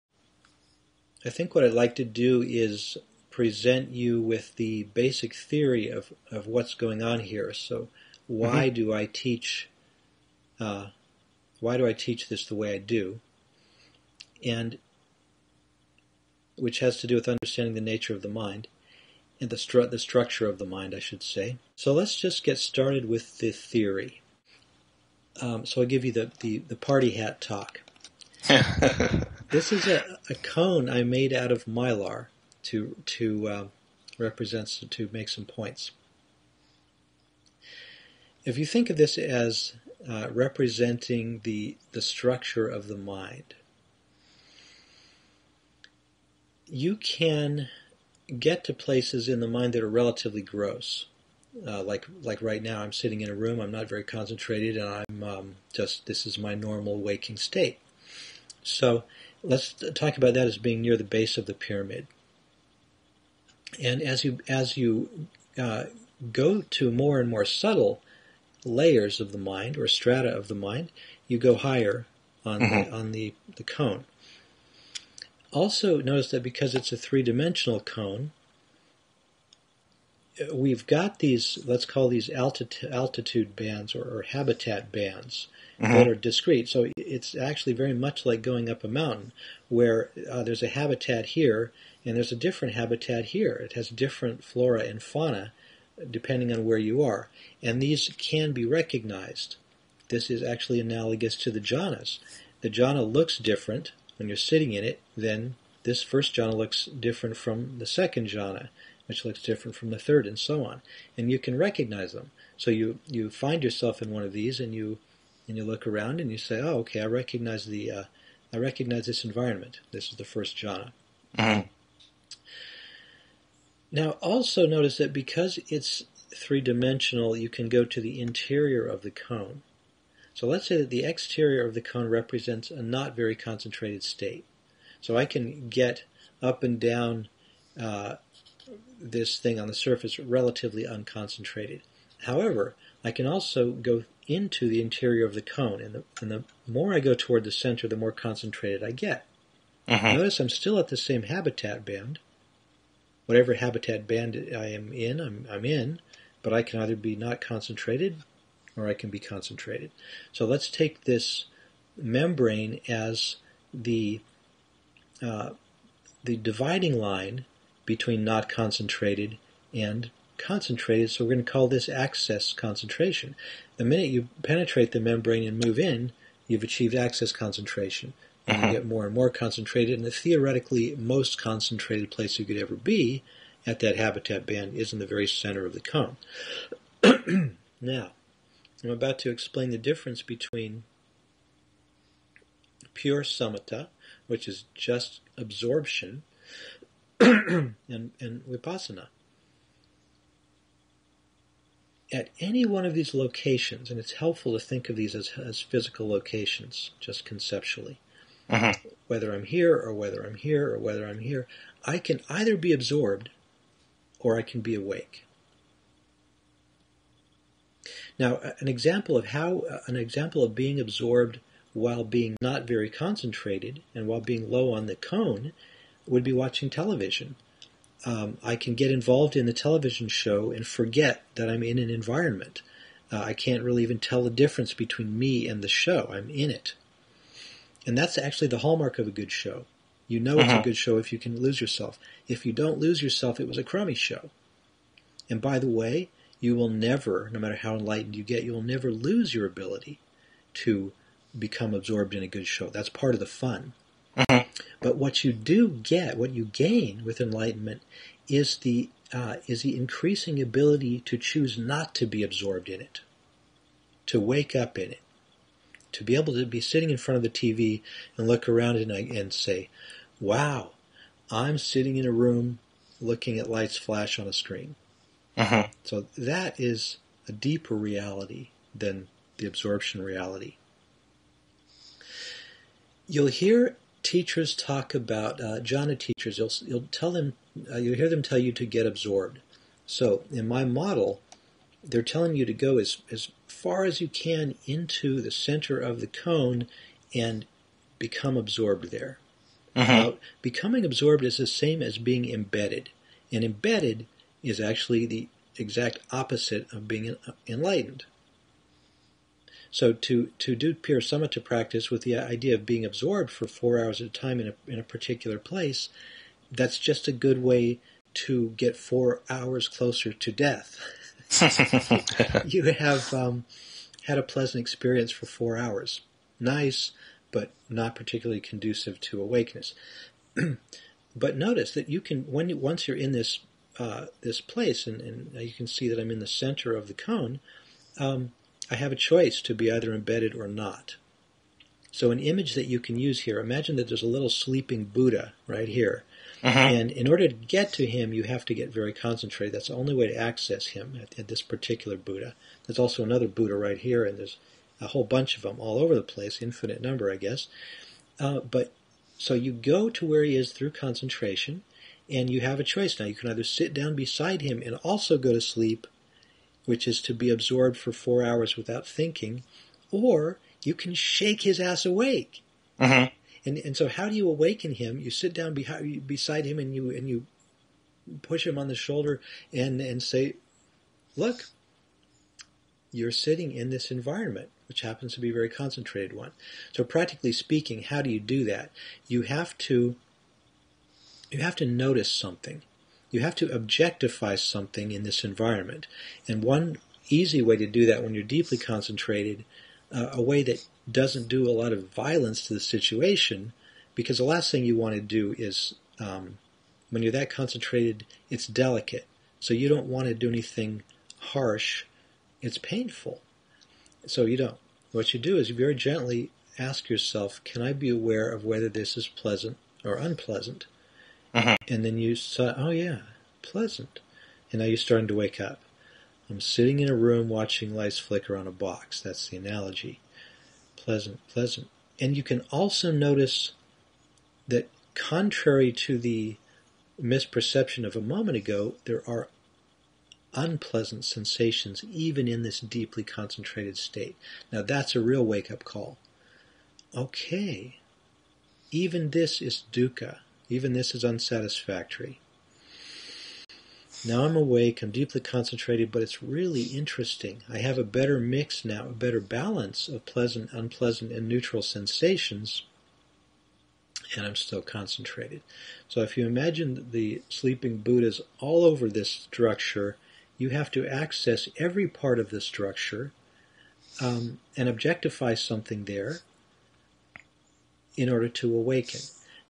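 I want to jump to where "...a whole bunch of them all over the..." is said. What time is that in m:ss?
5:54.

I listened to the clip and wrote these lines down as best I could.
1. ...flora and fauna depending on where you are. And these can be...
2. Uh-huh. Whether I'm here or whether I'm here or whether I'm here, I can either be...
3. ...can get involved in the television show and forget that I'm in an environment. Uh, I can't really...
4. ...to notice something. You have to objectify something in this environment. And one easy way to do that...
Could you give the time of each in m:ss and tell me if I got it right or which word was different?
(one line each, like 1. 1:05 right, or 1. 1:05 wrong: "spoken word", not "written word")
1. 1:34 right
2. 3:28 right
3. 3:48 right
4. 6:31 right.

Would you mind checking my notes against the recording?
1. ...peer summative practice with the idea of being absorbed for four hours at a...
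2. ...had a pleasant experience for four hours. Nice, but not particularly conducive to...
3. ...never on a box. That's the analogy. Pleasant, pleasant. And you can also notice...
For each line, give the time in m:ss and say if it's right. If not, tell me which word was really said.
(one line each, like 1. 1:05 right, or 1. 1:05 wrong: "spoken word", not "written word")
1. 5:10 right
2. 5:24 right
3. 7:07 wrong: "flicker", not "never".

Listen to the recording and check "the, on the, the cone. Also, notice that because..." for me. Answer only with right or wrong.
right.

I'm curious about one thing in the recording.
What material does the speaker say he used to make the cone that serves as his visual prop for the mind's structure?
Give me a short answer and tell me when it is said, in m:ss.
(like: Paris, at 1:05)
mylar, at 0:31.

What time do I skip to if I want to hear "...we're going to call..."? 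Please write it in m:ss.
2:51.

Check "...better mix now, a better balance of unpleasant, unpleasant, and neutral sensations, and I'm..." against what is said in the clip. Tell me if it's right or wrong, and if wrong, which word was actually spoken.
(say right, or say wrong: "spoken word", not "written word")
wrong: "pleasant", not "unpleasant".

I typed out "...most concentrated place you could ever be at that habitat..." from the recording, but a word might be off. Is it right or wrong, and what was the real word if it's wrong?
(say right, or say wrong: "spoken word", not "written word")
right.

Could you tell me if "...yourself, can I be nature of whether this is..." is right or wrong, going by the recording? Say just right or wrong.
wrong.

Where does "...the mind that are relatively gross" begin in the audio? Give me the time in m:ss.
0:49.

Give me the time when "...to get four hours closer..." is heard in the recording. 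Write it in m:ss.
5:18.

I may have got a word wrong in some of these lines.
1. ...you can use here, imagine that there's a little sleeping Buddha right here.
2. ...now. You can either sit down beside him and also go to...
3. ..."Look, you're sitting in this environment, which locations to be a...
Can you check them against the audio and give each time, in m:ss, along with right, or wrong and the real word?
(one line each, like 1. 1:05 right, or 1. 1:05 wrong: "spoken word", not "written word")
1. 5:42 right
2. 6:02 right
3. 6:21 wrong: "happens", not "locations".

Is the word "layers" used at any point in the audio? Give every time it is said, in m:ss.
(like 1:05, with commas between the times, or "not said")
1:08.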